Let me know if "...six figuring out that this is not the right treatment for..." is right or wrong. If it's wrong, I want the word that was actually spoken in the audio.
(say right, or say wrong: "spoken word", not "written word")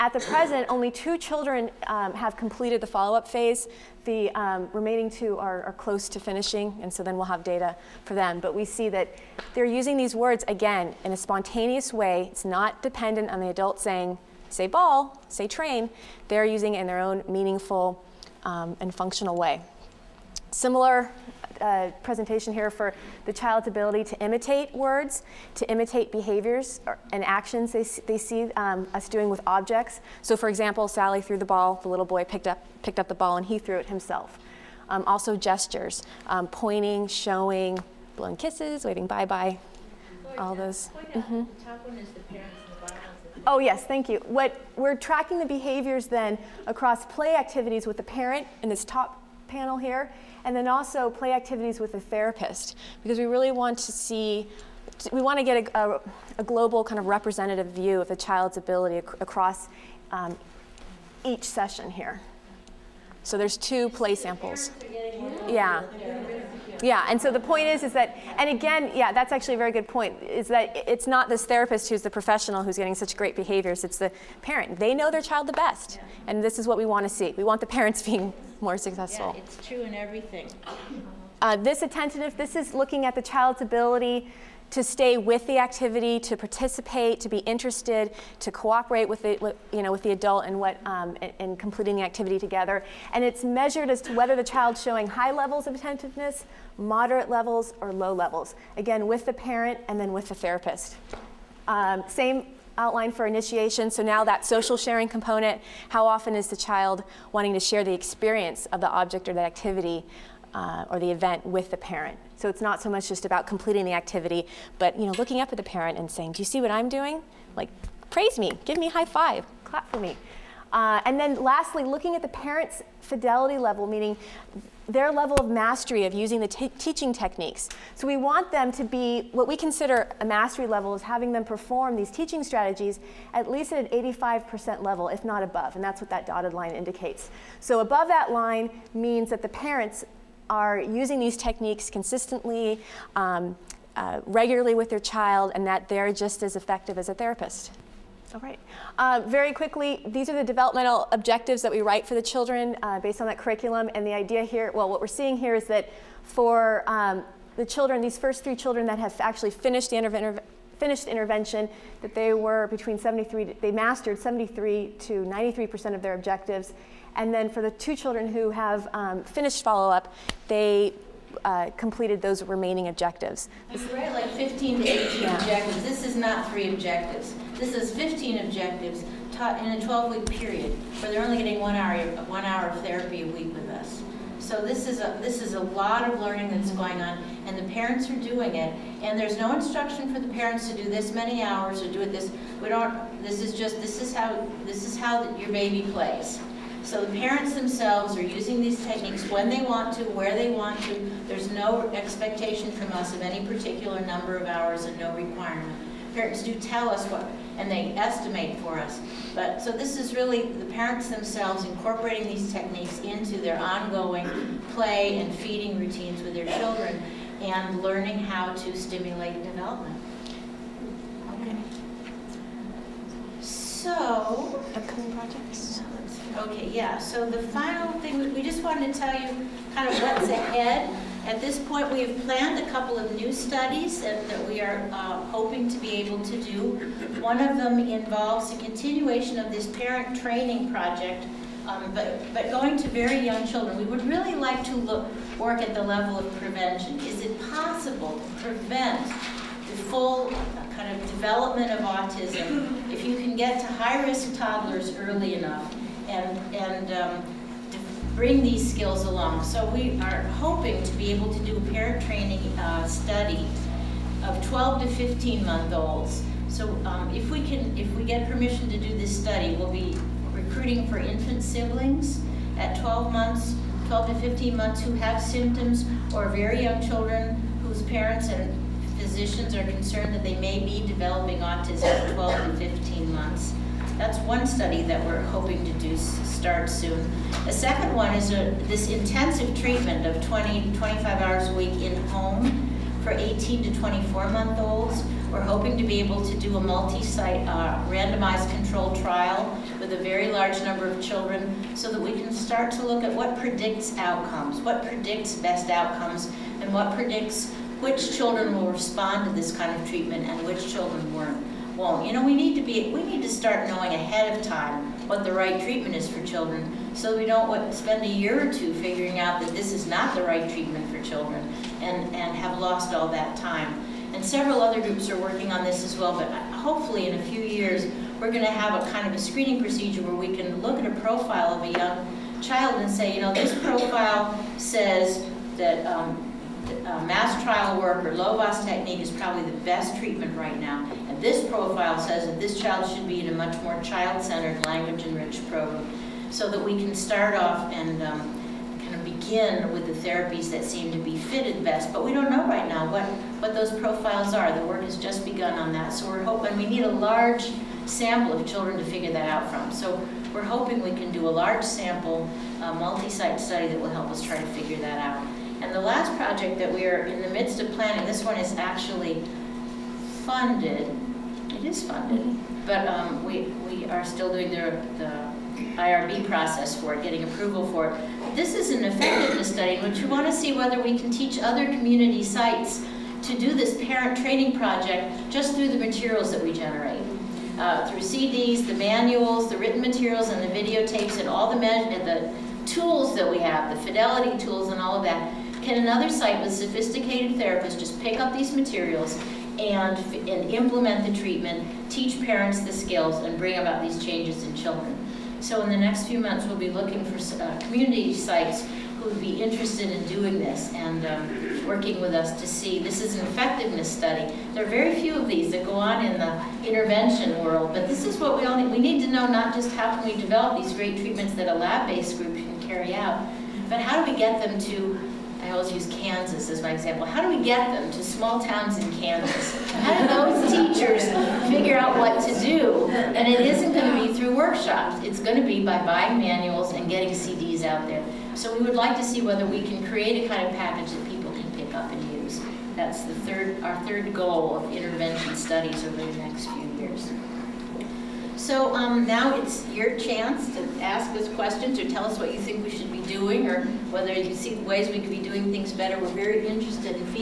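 wrong: "two", not "six".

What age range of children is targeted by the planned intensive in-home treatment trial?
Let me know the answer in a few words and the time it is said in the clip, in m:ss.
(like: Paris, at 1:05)
18 to 24 months, at 4:53.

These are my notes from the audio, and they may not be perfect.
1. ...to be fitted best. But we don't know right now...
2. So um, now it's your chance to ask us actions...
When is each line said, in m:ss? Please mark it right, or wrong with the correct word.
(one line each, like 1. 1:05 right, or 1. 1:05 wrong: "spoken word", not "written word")
1. 5:50 right
2. 7:28 wrong: "questions", not "actions".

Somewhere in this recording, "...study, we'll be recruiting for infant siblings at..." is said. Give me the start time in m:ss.
4:29.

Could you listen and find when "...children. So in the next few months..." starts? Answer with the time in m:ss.
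6:44.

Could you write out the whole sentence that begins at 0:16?
They're using it in their own meaningful um, and functional way.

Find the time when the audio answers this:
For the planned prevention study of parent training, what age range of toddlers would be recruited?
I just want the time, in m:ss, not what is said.
4:24.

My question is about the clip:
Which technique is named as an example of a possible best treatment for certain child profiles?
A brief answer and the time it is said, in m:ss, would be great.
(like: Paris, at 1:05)
Lovaas technique, at 5:38.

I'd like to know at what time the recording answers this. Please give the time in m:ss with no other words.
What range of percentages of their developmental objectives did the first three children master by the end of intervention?
2:44.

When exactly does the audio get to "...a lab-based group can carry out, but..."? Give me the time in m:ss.
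7:01.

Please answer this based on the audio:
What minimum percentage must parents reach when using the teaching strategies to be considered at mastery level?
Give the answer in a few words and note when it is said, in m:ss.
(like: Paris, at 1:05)
85%, at 2:13.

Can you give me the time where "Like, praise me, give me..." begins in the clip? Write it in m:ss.
1:57.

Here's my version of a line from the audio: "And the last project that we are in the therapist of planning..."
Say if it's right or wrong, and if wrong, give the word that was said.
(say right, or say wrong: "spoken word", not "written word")
wrong: "midst", not "therapist".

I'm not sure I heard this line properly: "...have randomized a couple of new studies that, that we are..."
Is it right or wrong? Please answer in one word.
wrong.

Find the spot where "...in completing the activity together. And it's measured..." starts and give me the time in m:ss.
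1:31.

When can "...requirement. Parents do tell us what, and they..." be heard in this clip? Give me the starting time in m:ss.
3:25.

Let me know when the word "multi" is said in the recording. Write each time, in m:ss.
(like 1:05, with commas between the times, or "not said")
4:56, 6:02.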